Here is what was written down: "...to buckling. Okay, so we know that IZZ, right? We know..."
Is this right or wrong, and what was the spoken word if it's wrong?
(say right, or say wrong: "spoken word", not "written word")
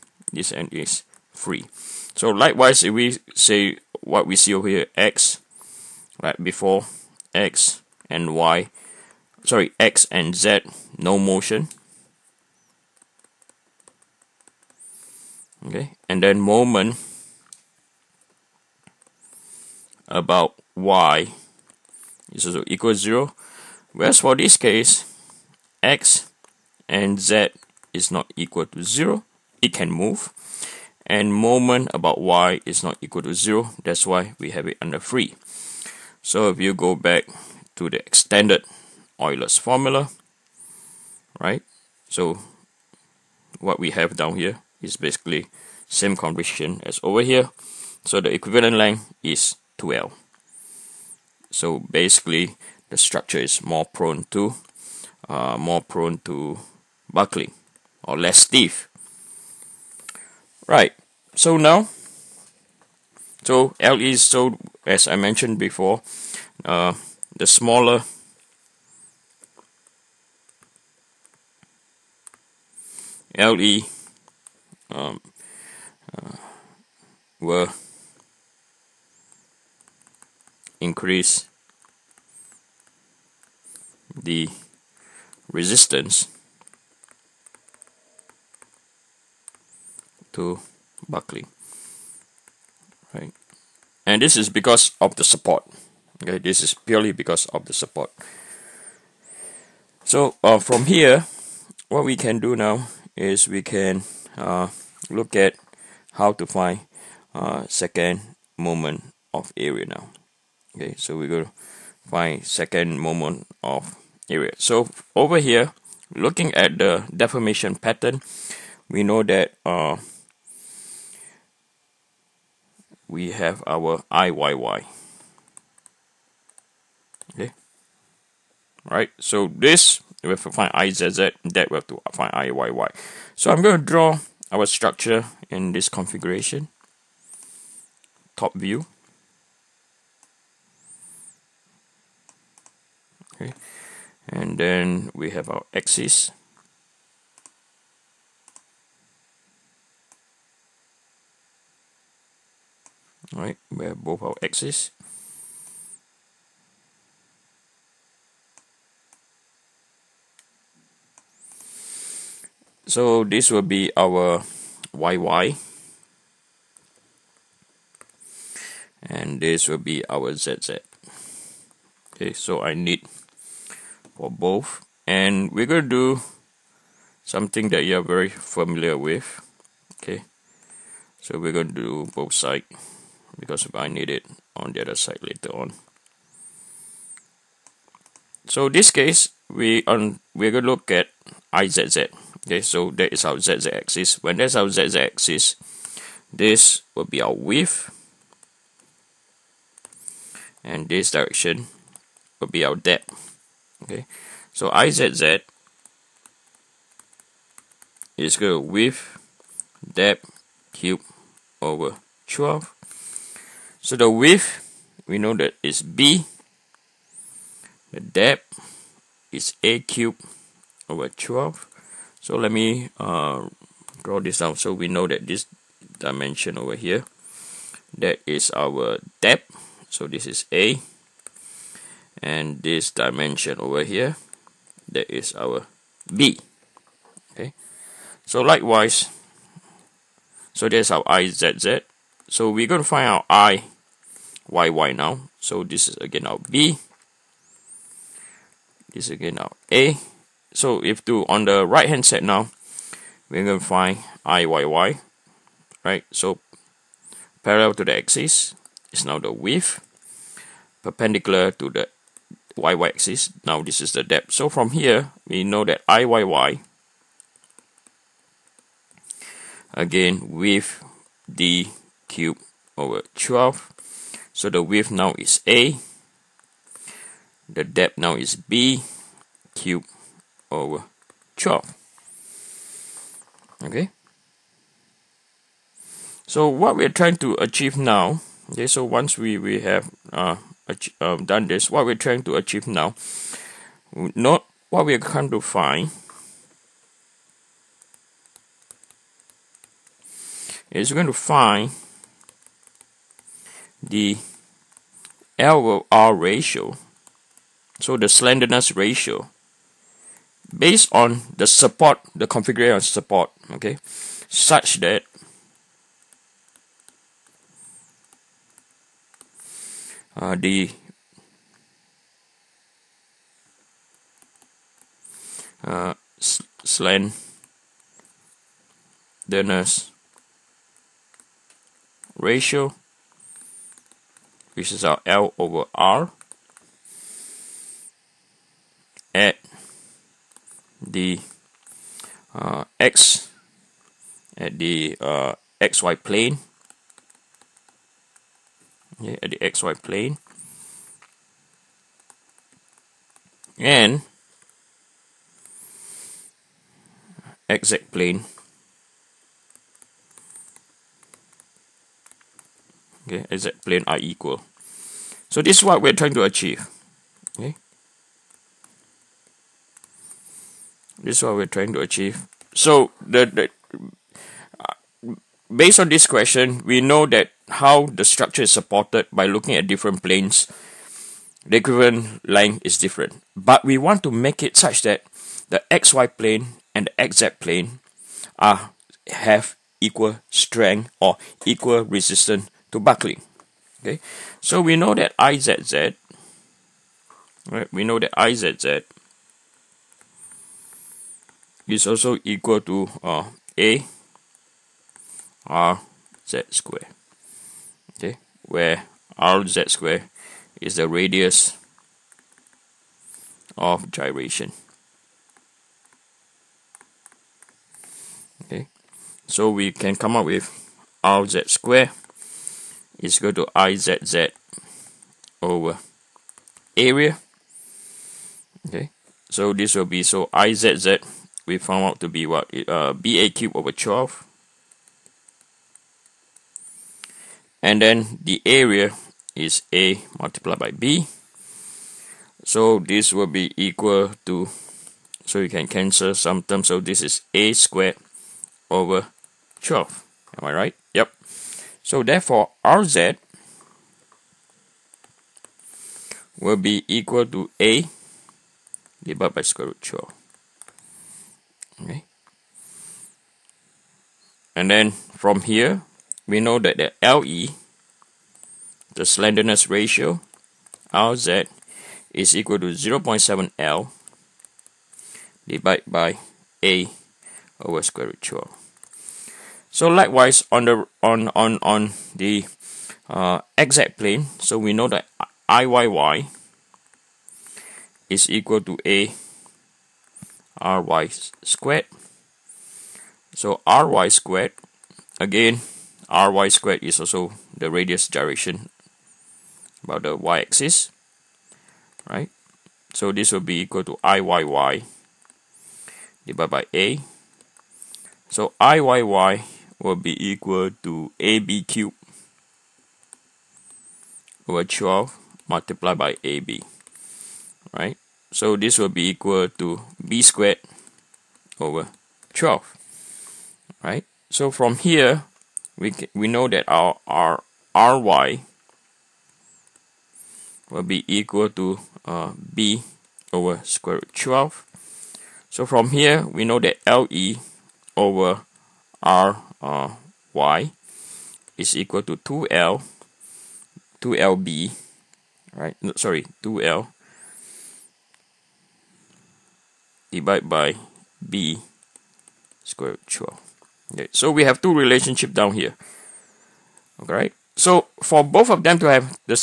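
right.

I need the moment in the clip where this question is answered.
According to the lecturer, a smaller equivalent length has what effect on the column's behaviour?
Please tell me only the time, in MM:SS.
01:17.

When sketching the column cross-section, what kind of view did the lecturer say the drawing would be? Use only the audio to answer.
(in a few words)
Top view.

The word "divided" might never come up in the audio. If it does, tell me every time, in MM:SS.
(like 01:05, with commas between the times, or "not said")
07:39, 07:55, 08:26, 09:10.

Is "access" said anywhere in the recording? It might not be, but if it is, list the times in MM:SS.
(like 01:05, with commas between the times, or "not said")
02:34.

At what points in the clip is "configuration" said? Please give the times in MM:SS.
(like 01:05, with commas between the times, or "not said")
02:15, 05:12.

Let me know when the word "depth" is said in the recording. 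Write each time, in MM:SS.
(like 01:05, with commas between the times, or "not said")
03:22, 03:29, 03:38, 03:49, 04:24, 04:37.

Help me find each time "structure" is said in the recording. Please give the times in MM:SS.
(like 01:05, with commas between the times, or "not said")
00:52, 02:14, 06:18.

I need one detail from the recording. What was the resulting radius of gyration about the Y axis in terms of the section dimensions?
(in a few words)
B over square root 12.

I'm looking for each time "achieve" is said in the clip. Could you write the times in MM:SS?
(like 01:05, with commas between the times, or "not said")
04:47, 04:52, 06:06, 06:11.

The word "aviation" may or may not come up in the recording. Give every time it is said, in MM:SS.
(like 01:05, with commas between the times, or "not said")
not said.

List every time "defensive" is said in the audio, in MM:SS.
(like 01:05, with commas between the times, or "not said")
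not said.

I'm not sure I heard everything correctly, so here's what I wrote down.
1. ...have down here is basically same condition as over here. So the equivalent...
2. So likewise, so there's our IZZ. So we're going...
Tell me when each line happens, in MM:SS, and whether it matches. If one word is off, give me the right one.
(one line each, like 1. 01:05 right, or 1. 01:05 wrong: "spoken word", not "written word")
1. 00:43 right
2. 03:58 right.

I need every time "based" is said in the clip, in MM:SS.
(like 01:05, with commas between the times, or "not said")
05:10, 06:15.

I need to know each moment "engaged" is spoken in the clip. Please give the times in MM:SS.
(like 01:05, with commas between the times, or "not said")
not said.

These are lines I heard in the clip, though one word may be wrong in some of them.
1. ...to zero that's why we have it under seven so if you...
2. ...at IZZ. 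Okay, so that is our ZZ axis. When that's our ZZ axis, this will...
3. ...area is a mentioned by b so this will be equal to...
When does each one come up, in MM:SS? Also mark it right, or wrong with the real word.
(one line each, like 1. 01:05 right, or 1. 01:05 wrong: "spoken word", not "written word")
1. 00:33 wrong: "three", not "seven"
2. 03:10 right
3. 07:18 wrong: "multiplied", not "mentioned".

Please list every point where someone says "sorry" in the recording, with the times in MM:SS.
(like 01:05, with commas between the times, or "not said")
00:09, 09:05.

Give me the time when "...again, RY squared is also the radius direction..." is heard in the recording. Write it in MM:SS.
08:15.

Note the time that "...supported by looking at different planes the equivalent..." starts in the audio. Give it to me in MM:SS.
06:18.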